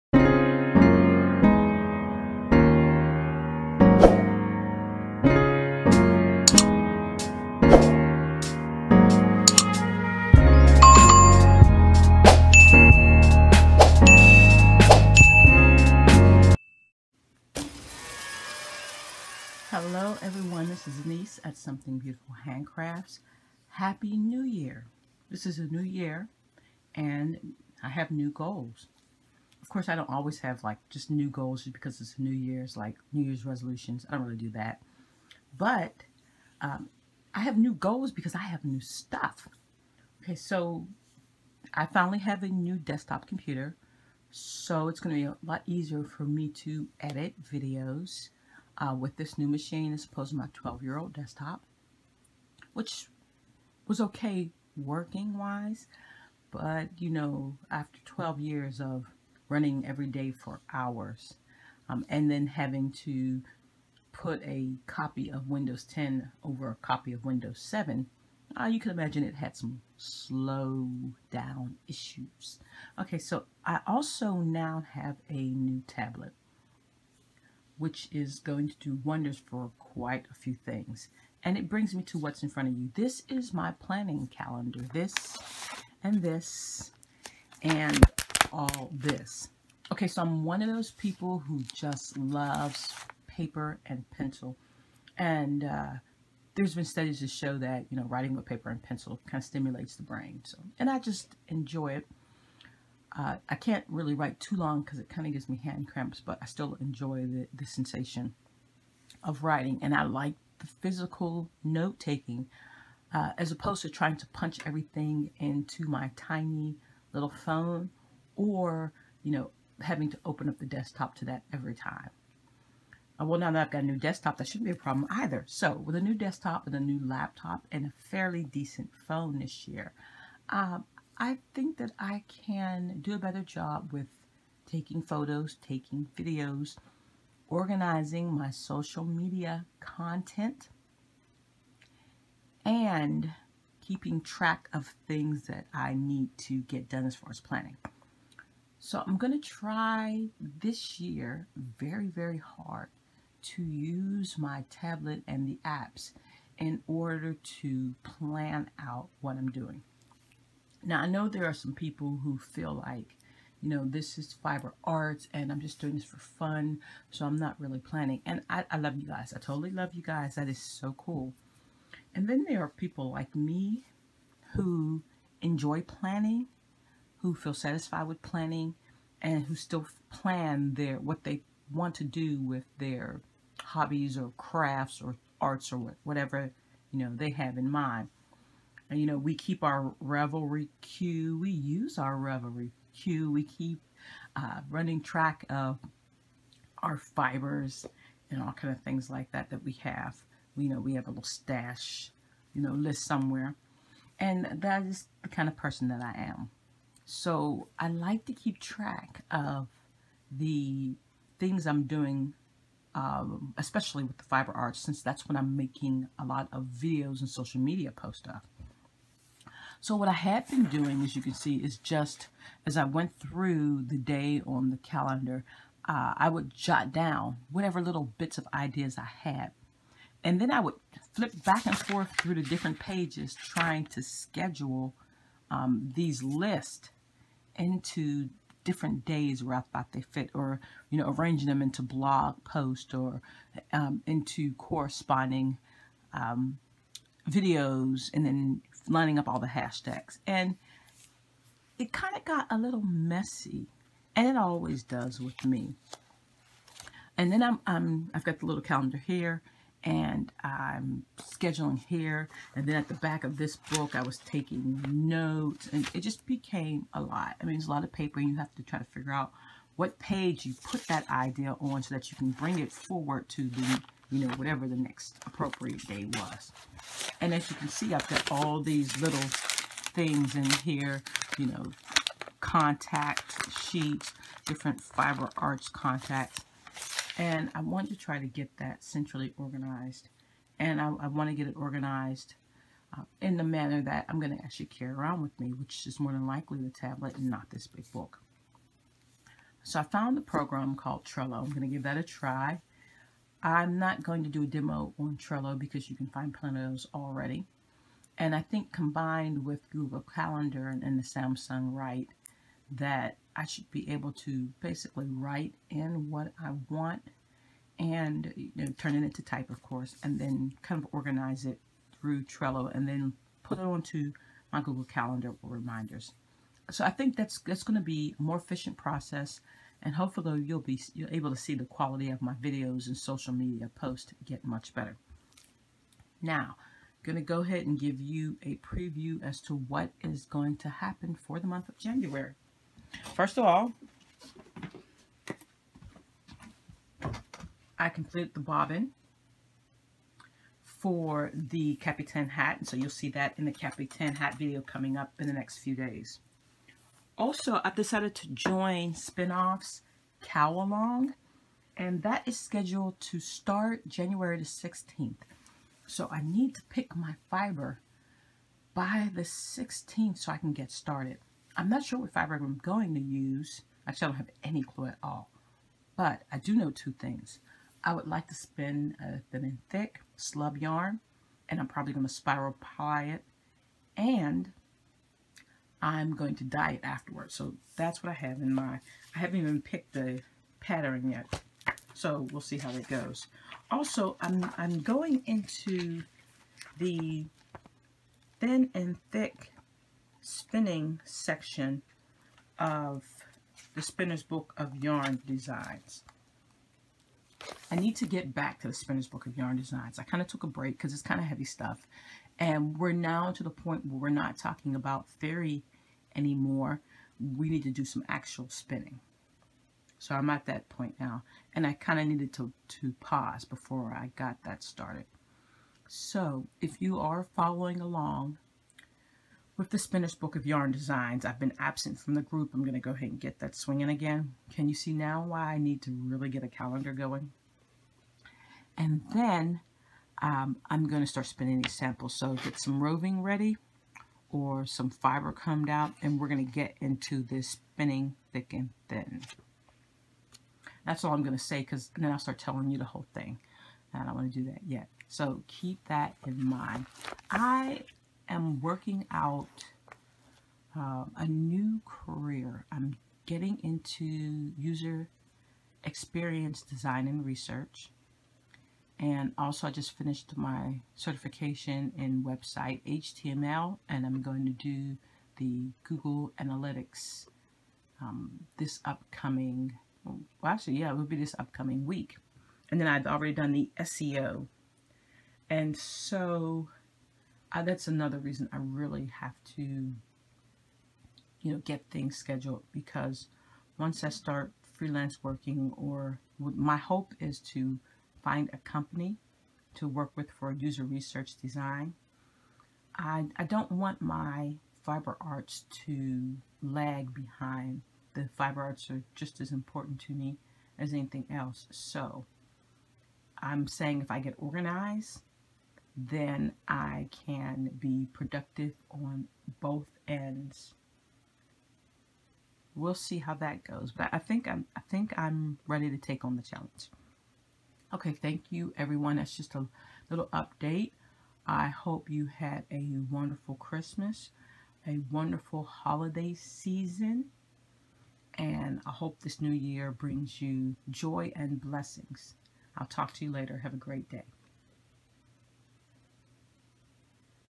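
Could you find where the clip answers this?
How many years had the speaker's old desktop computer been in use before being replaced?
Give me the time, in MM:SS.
00:50.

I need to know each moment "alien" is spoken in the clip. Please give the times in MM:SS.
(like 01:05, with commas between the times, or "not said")
not said.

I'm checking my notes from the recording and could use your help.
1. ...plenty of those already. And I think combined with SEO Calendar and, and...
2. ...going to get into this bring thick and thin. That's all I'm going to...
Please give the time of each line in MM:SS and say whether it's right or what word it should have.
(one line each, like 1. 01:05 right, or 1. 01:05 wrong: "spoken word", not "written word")
1. 05:06 wrong: "Google", not "SEO"
2. 07:26 wrong: "spinning", not "bring".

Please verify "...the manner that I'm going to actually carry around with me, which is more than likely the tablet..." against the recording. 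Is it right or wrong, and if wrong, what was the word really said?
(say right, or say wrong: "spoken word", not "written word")
right.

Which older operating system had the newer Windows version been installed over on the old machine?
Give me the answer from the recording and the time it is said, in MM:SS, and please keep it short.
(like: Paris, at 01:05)
Windows 7, at 01:07.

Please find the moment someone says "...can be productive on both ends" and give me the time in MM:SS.
08:37.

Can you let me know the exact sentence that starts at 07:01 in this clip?
And I kind of needed to, to pause before I got that started.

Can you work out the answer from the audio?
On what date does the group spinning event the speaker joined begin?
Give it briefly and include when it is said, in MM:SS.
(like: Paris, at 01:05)
January 16, at 06:03.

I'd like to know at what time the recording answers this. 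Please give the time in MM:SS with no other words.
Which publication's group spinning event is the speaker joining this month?
05:58.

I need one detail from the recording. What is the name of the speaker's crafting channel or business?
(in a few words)
Something Beautiful Handcrafts.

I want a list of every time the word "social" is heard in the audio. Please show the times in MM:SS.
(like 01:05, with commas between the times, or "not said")
02:18, 03:37, 05:32.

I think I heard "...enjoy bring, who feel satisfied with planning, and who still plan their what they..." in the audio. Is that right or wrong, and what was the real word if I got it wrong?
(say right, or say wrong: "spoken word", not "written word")
wrong: "planning", not "bring".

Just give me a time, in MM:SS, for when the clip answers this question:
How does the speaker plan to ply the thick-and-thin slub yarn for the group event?
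06:22.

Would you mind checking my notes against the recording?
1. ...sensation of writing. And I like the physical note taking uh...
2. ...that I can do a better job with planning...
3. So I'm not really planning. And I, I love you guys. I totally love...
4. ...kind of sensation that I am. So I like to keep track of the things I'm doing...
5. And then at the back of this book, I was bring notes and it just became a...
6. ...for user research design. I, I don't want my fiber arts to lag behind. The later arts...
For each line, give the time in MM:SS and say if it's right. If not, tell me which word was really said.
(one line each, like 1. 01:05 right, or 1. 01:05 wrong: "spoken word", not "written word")
1. 01:47 right
2. 02:11 wrong: "taking", not "planning"
3. 02:47 right
4. 03:25 wrong: "person", not "sensation"
5. 04:22 wrong: "taking", not "bring"
6. 08:20 wrong: "fiber", not "later".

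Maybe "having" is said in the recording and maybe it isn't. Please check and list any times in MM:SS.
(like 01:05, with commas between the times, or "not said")
01:02, 01:59.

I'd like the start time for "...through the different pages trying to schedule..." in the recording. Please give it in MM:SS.
03:52.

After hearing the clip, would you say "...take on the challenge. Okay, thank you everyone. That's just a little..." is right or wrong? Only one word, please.
right.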